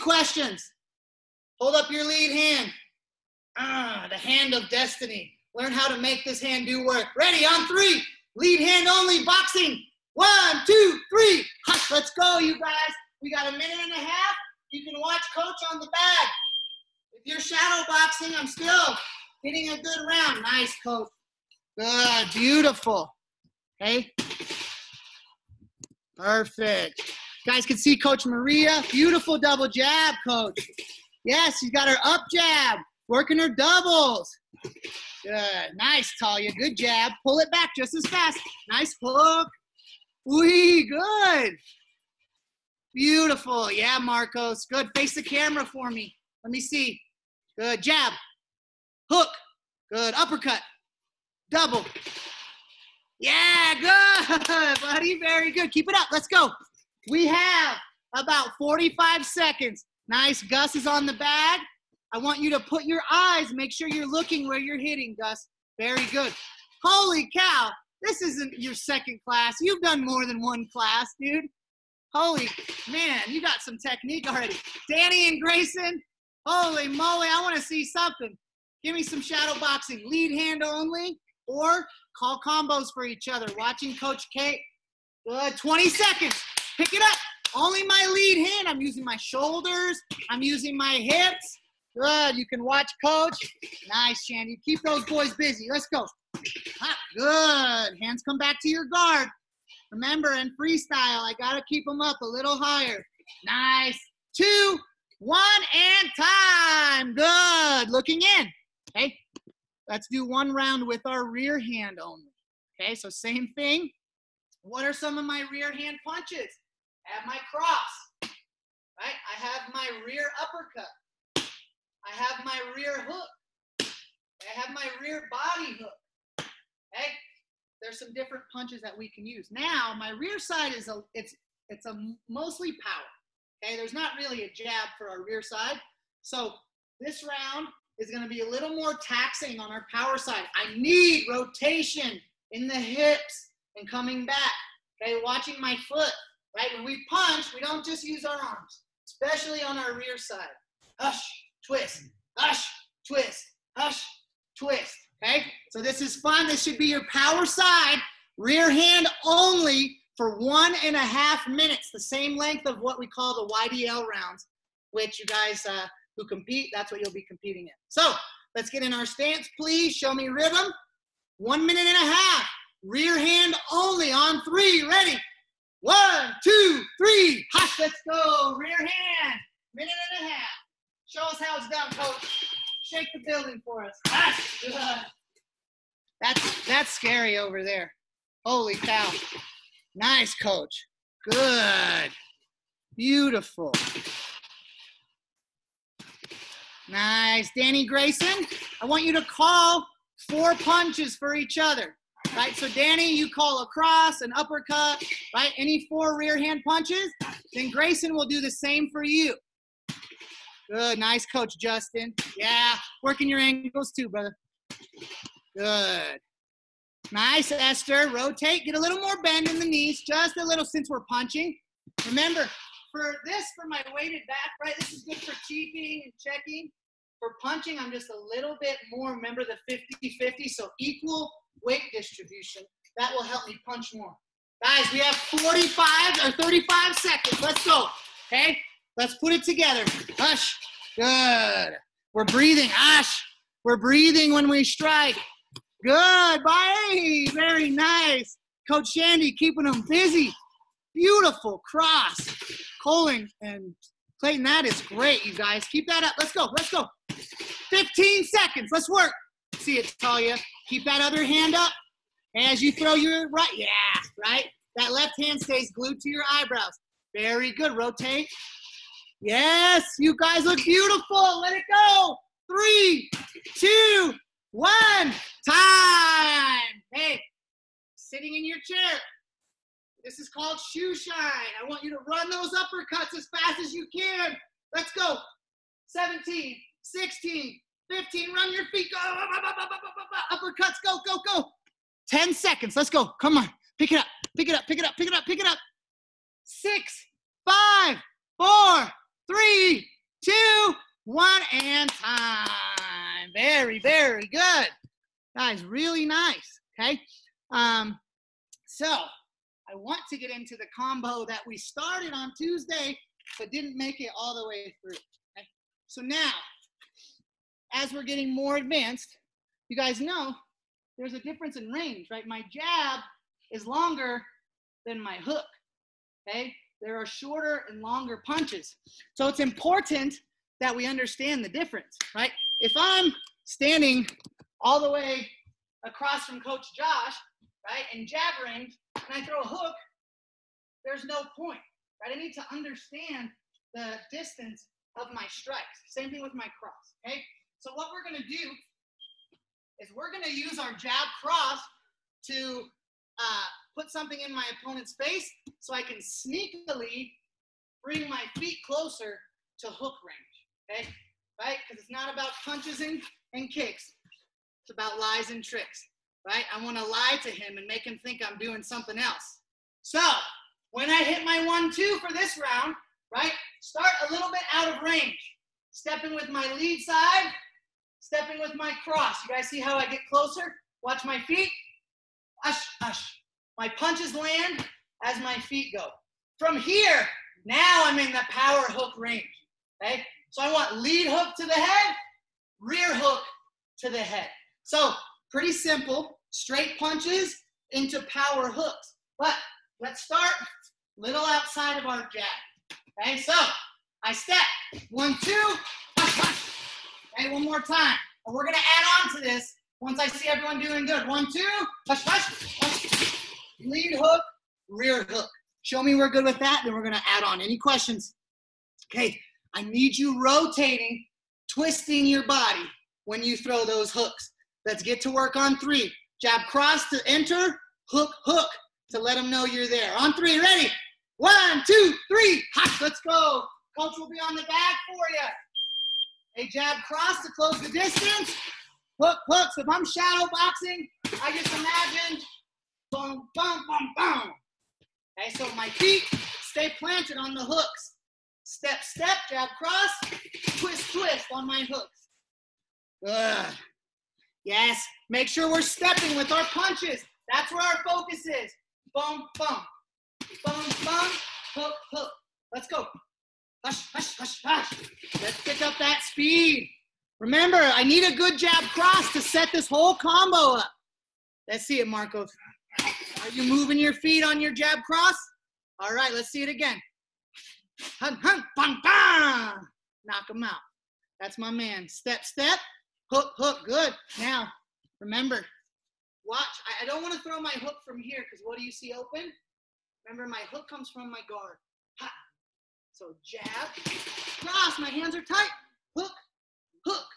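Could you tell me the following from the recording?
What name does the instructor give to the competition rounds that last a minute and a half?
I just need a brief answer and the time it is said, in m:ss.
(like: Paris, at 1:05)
YDL rounds, at 2:43.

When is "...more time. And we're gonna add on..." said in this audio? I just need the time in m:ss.
6:47.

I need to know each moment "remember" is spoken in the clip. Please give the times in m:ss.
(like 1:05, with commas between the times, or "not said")
1:39, 3:42, 3:49, 7:47, 8:04, 8:10.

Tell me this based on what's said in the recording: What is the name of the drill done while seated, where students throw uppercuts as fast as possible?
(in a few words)
Shoe shine.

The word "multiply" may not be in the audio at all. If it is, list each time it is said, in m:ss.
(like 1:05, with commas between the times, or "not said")
not said.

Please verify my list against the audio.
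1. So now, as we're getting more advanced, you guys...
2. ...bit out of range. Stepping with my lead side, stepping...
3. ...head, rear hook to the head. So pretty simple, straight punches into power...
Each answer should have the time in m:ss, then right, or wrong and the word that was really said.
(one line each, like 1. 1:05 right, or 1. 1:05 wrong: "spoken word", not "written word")
1. 5:15 right
2. 6:14 right
3. 6:31 right.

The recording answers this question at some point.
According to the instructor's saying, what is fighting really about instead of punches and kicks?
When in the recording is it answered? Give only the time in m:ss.
6:04.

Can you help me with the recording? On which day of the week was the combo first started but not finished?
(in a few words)
Tuesday.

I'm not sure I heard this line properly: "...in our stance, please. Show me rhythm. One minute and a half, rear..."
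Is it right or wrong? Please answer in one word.
right.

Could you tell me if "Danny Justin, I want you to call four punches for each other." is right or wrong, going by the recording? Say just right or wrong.
wrong.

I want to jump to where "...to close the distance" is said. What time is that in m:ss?
7:17.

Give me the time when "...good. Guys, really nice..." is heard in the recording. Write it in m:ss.
5:04.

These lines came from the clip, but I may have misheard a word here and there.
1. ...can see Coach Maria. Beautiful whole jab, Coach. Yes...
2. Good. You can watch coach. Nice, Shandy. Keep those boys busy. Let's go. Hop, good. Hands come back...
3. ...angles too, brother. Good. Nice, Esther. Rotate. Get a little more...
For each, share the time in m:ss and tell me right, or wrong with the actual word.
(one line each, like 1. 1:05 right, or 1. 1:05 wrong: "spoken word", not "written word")
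1. 0:27 wrong: "double", not "whole"
2. 1:31 right
3. 3:33 right.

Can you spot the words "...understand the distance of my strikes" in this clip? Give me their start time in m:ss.
5:42.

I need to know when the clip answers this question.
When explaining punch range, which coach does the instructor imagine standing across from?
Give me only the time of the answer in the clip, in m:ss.
5:36.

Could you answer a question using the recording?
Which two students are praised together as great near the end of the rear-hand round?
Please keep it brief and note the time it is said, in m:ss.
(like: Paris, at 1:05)
Colin and Clayton, at 4:12.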